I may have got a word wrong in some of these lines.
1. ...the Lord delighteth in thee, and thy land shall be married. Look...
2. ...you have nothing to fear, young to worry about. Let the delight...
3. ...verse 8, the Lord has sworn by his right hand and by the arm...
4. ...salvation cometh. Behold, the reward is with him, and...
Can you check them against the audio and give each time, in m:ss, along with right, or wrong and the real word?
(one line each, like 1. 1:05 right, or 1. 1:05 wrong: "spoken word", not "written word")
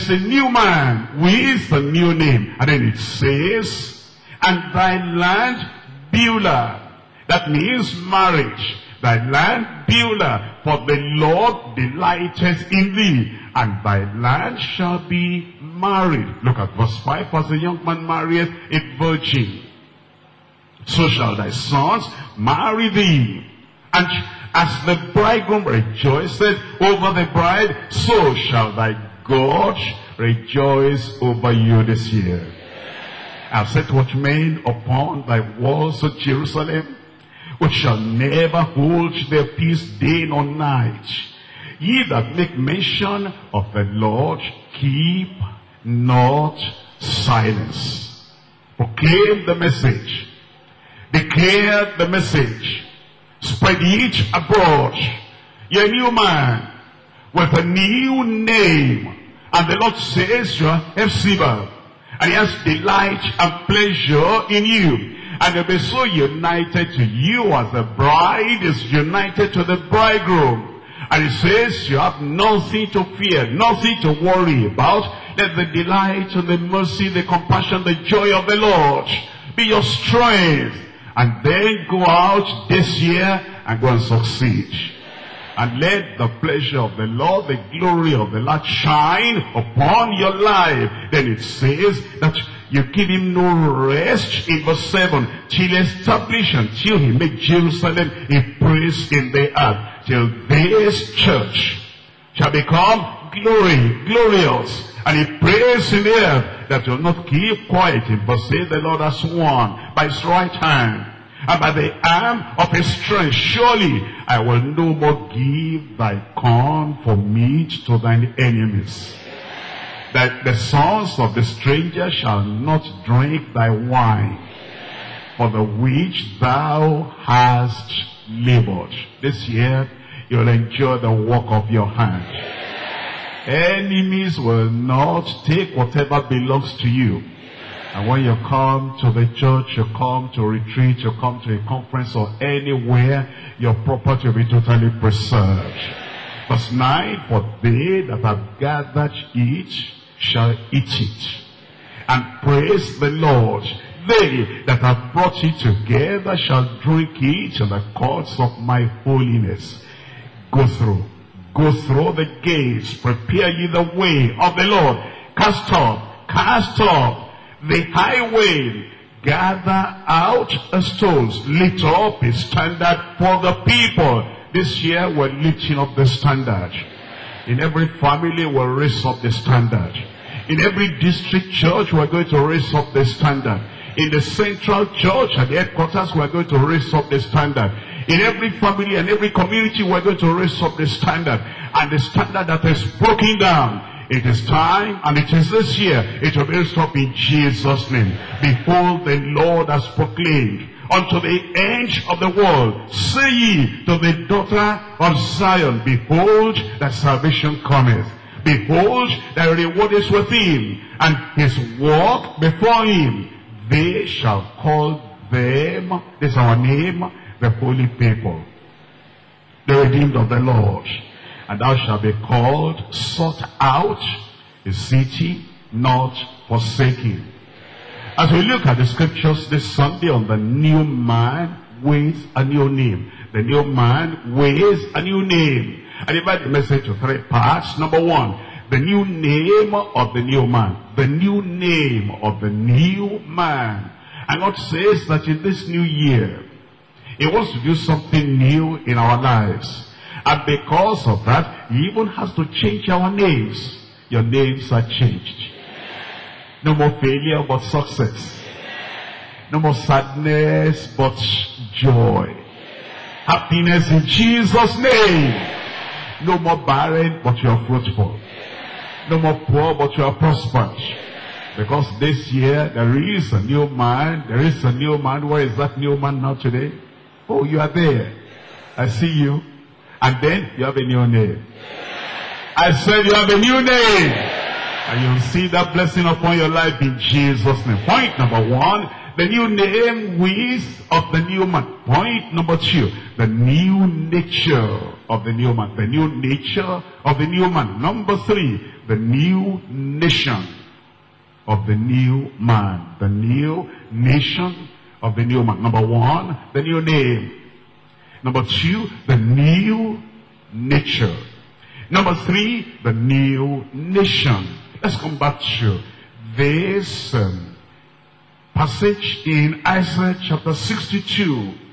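1. 0:10 right
2. 1:11 wrong: "nothing", not "young"
3. 1:48 right
4. 3:26 right.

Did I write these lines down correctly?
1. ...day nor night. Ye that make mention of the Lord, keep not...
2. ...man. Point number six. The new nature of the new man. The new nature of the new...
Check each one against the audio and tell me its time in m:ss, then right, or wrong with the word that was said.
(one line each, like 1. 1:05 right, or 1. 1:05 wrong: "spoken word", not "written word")
1. 0:39 right
2. 4:51 wrong: "two", not "six".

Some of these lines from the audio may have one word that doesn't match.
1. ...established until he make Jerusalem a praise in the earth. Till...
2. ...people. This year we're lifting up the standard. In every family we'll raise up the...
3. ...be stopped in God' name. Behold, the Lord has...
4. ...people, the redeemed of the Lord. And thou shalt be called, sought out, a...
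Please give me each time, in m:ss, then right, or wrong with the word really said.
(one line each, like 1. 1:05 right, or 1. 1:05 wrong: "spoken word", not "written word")
1. 1:35 right
2. 2:53 right
3. 3:16 wrong: "Jesus", not "God"
4. 3:37 right.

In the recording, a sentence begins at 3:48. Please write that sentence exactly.
As we look at the scriptures this Sunday on the new man with a new name.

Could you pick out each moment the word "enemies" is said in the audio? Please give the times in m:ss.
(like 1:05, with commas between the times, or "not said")
1:58, 2:13.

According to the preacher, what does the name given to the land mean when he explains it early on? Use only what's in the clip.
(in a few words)
marriage.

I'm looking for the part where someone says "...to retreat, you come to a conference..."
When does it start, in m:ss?
2:20.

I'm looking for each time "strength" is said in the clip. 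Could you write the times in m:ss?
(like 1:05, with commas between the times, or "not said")
1:19, 1:52.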